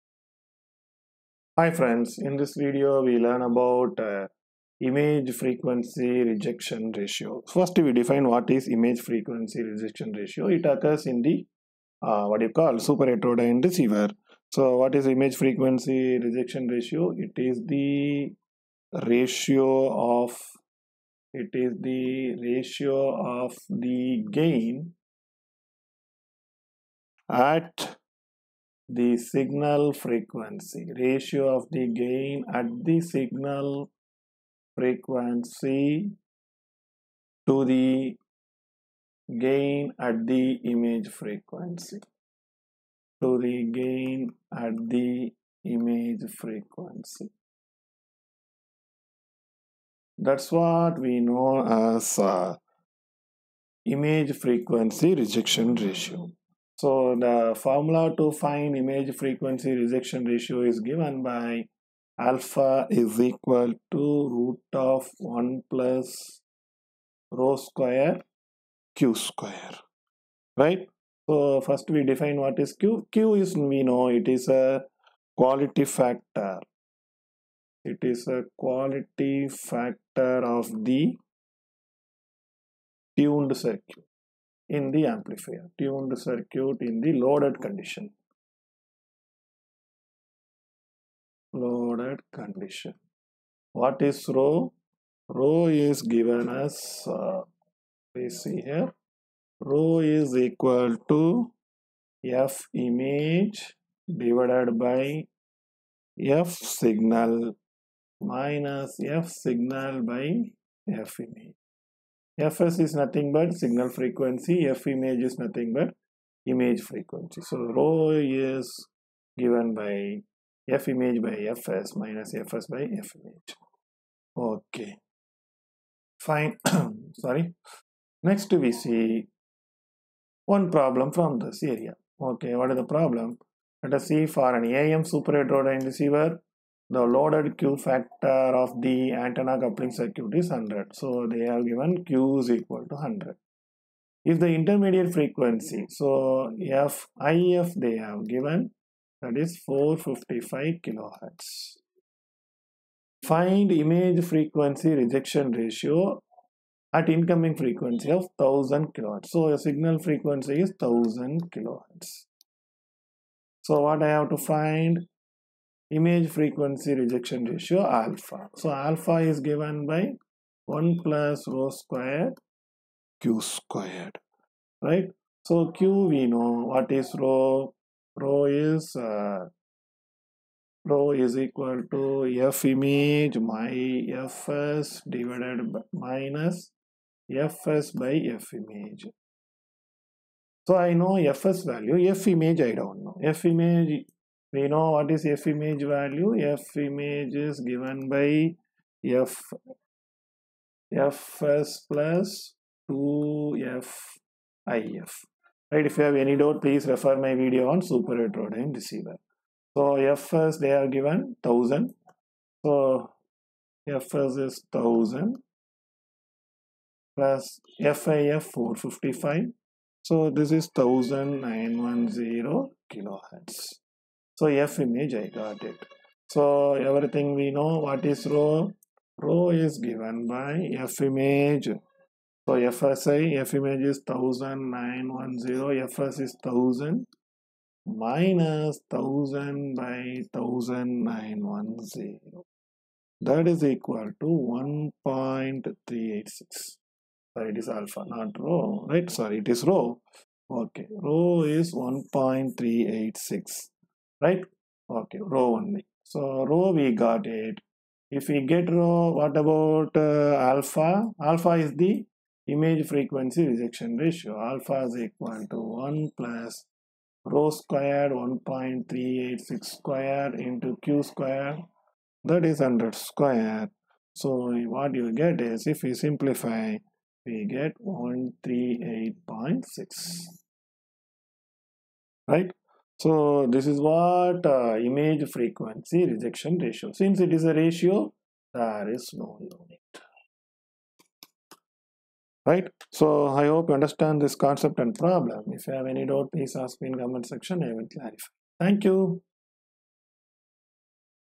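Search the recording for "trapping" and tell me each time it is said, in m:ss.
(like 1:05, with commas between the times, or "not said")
not said.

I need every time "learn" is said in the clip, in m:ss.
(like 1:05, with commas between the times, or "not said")
0:03.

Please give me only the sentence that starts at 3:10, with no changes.
So I know fs value, f image I don't know.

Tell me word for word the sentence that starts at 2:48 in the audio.
So alpha is given by 1 plus rho squared q squared, right?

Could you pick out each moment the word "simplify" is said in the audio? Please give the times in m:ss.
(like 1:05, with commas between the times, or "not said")
4:36.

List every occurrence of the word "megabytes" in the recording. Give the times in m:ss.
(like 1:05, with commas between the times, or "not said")
not said.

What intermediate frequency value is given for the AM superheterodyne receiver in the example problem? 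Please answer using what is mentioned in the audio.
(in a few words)
455 kilohertz.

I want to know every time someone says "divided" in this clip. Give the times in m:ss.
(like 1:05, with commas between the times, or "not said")
1:44, 3:05.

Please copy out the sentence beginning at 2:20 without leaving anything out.
So they have given Q is equal to 100.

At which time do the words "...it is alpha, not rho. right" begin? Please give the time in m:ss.
4:07.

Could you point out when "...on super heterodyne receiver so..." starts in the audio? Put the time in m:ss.
3:27.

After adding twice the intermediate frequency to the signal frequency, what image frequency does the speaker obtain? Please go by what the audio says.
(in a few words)
1910 kilohertz.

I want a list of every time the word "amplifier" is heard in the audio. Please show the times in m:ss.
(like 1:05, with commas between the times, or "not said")
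1:25.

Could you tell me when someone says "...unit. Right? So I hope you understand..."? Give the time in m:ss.
4:49.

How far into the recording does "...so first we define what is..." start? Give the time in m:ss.
1:11.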